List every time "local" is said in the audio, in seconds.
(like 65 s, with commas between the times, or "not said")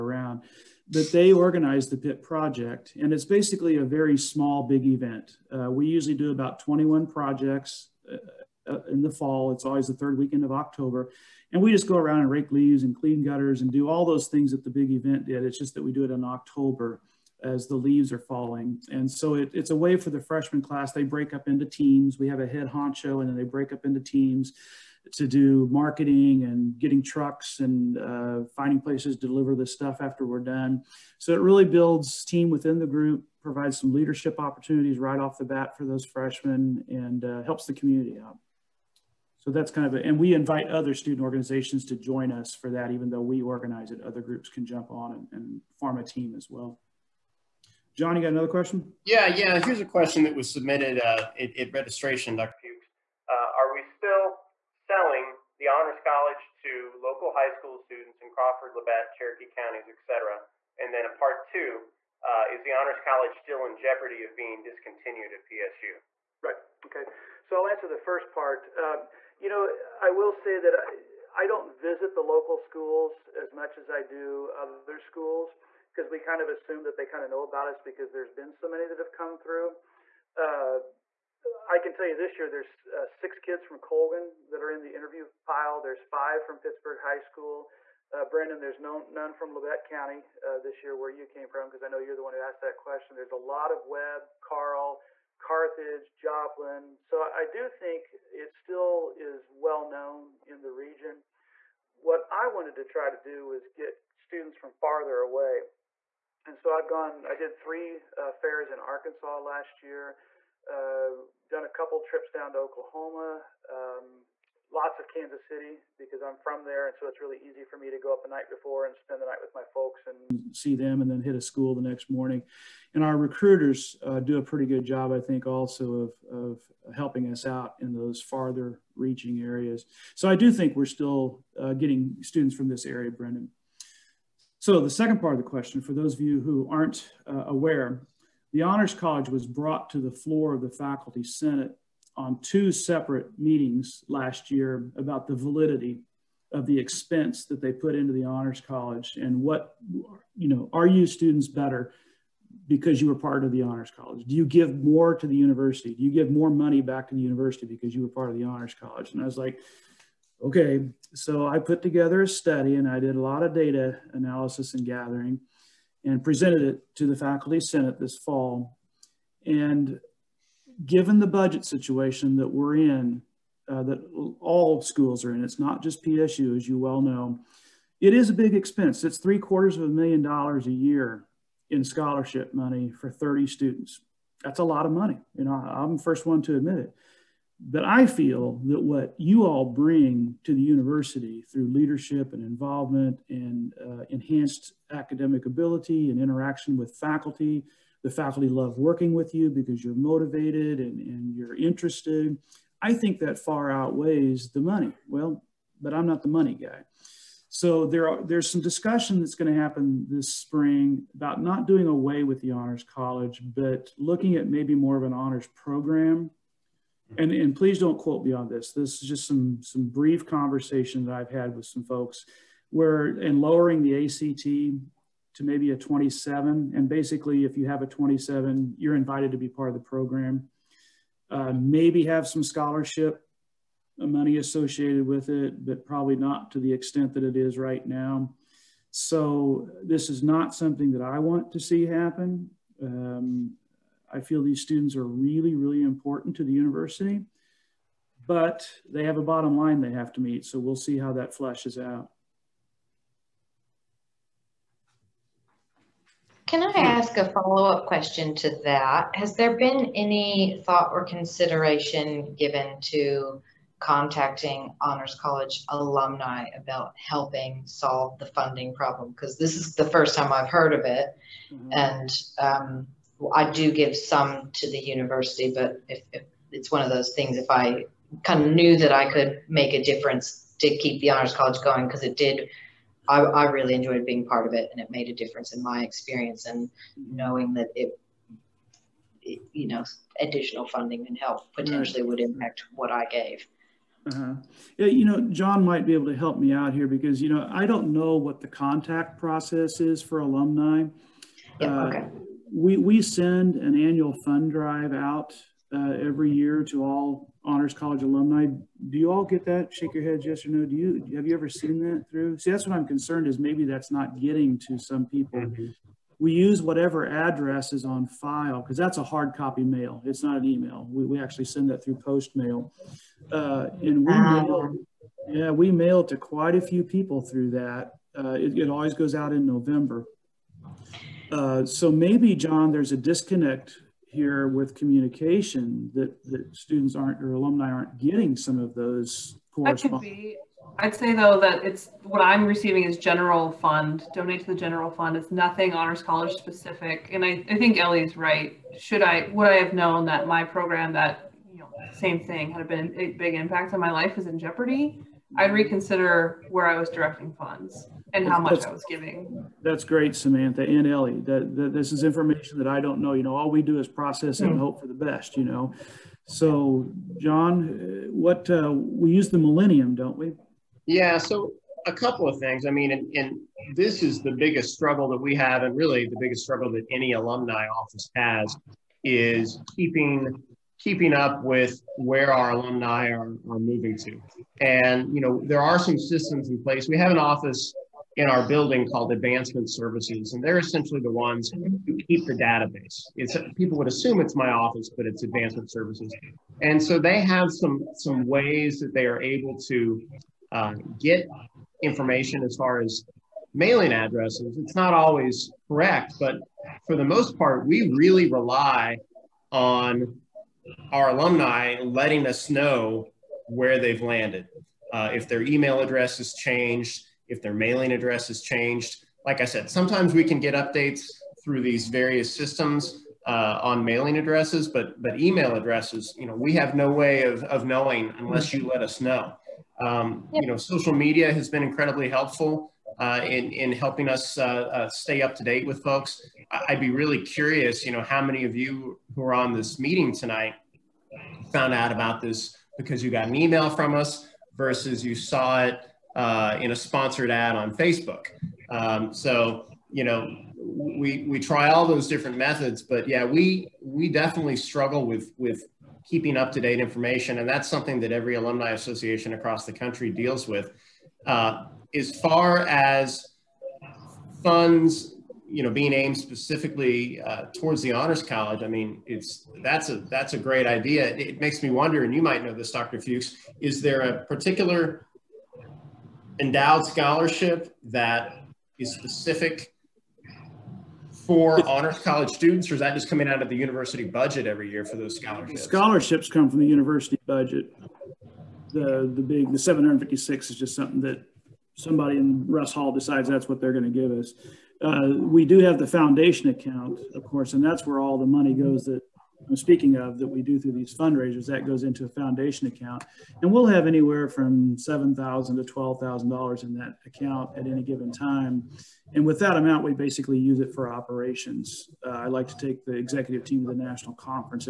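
56 s, 72 s.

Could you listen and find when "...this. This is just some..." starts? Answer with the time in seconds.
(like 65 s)
218 s.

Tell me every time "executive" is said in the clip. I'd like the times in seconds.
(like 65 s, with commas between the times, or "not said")
512 s.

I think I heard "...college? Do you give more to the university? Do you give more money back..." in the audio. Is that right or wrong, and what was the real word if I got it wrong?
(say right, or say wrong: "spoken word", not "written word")
right.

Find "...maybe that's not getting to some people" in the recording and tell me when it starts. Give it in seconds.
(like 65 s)
313 s.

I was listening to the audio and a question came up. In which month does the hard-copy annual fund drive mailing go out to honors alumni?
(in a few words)
November.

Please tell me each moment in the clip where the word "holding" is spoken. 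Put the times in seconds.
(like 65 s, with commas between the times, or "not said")
not said.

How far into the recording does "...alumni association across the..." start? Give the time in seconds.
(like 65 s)
458 s.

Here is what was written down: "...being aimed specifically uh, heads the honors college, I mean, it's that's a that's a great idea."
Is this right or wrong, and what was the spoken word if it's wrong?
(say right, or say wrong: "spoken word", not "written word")
wrong: "towards", not "heads".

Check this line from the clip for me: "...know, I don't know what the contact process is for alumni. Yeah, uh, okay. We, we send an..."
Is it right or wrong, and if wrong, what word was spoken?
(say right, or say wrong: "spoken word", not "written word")
right.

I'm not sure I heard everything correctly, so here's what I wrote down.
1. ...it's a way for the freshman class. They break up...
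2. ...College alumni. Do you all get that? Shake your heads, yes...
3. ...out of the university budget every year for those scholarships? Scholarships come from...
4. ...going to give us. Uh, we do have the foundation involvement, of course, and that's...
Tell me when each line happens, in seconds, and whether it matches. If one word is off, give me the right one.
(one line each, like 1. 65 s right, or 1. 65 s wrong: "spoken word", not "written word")
1. 19 s right
2. 307 s right
3. 483 s right
4. 493 s wrong: "account", not "involvement".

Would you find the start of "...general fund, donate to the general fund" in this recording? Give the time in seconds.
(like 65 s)
342 s.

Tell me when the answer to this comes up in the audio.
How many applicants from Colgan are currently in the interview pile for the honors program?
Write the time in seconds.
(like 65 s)
83 s.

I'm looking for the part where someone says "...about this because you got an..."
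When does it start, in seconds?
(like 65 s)
441 s.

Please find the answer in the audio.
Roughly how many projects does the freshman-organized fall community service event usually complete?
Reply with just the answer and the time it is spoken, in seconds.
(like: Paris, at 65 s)
21, at 6 s.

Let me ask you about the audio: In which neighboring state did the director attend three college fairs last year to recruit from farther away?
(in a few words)
Arkansas.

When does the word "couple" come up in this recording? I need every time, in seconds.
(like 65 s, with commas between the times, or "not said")
111 s, 371 s.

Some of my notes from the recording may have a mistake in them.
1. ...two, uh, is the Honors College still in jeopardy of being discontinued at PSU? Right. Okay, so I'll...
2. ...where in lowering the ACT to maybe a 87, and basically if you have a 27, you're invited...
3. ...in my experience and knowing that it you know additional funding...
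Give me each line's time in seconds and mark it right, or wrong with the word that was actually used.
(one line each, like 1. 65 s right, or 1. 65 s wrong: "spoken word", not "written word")
1. 61 s right
2. 222 s wrong: "27", not "87"
3. 285 s right.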